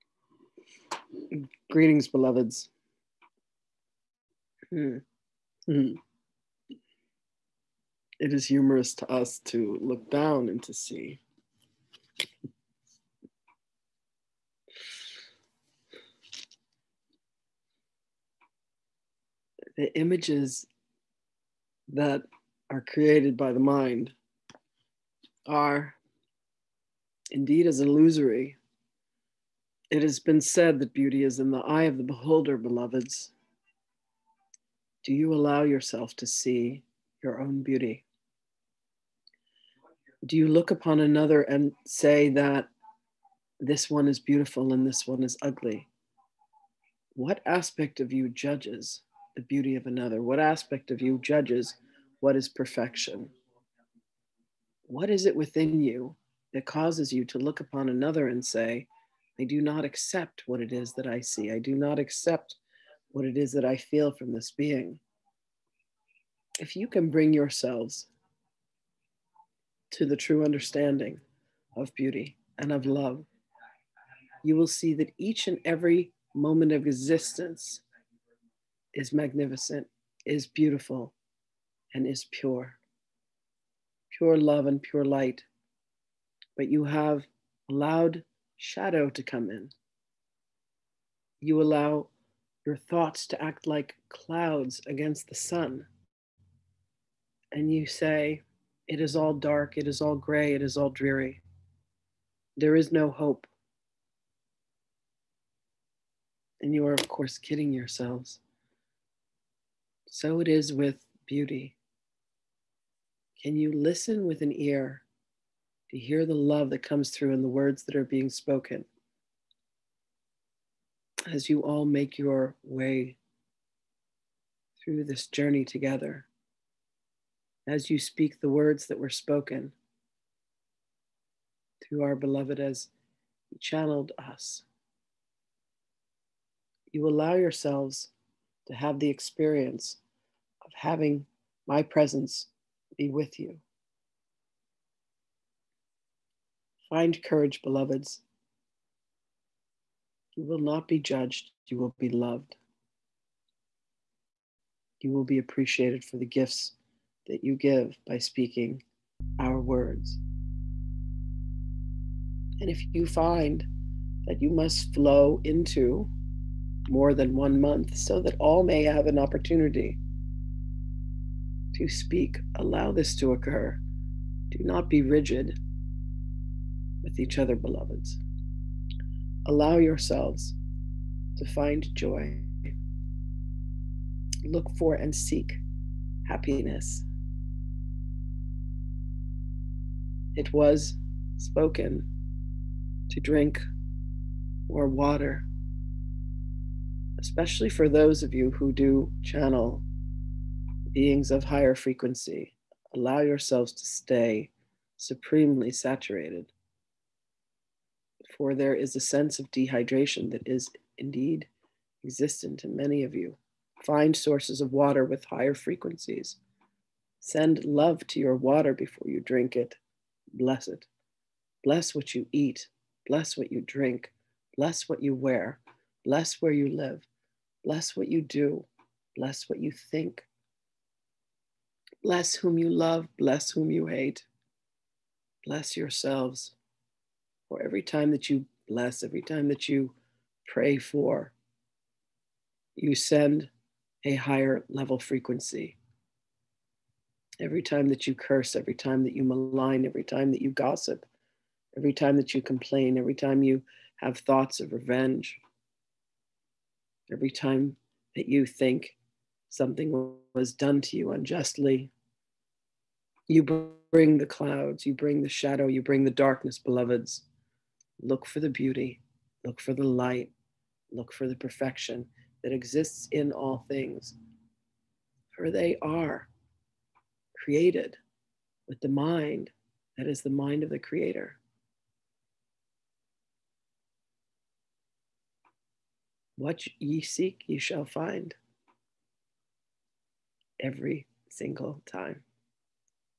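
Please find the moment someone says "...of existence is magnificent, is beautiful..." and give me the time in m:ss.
1:16.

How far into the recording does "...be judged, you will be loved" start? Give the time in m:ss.
2:30.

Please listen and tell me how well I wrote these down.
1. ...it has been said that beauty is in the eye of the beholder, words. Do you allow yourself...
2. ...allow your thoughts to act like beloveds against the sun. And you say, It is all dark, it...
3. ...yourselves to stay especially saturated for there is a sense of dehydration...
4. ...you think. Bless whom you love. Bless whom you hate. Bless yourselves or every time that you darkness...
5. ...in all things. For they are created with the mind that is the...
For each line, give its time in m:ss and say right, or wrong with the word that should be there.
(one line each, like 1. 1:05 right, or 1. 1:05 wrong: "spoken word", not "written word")
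1. 0:29 wrong: "beloveds", not "words"
2. 1:31 wrong: "clouds", not "beloveds"
3. 3:23 wrong: "supremely", not "especially"
4. 3:49 wrong: "bless", not "darkness"
5. 4:33 right.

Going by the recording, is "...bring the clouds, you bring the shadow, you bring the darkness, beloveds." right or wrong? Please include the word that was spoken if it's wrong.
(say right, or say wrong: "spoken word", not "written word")
right.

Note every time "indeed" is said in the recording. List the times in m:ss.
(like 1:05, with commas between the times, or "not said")
0:27, 3:30.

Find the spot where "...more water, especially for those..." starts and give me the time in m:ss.
3:14.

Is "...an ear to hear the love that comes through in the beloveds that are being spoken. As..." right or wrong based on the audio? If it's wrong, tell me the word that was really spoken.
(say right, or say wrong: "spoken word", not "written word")
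wrong: "words", not "beloveds".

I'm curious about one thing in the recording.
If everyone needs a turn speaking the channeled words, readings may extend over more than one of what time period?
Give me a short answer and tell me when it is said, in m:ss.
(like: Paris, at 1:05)
month, at 2:47.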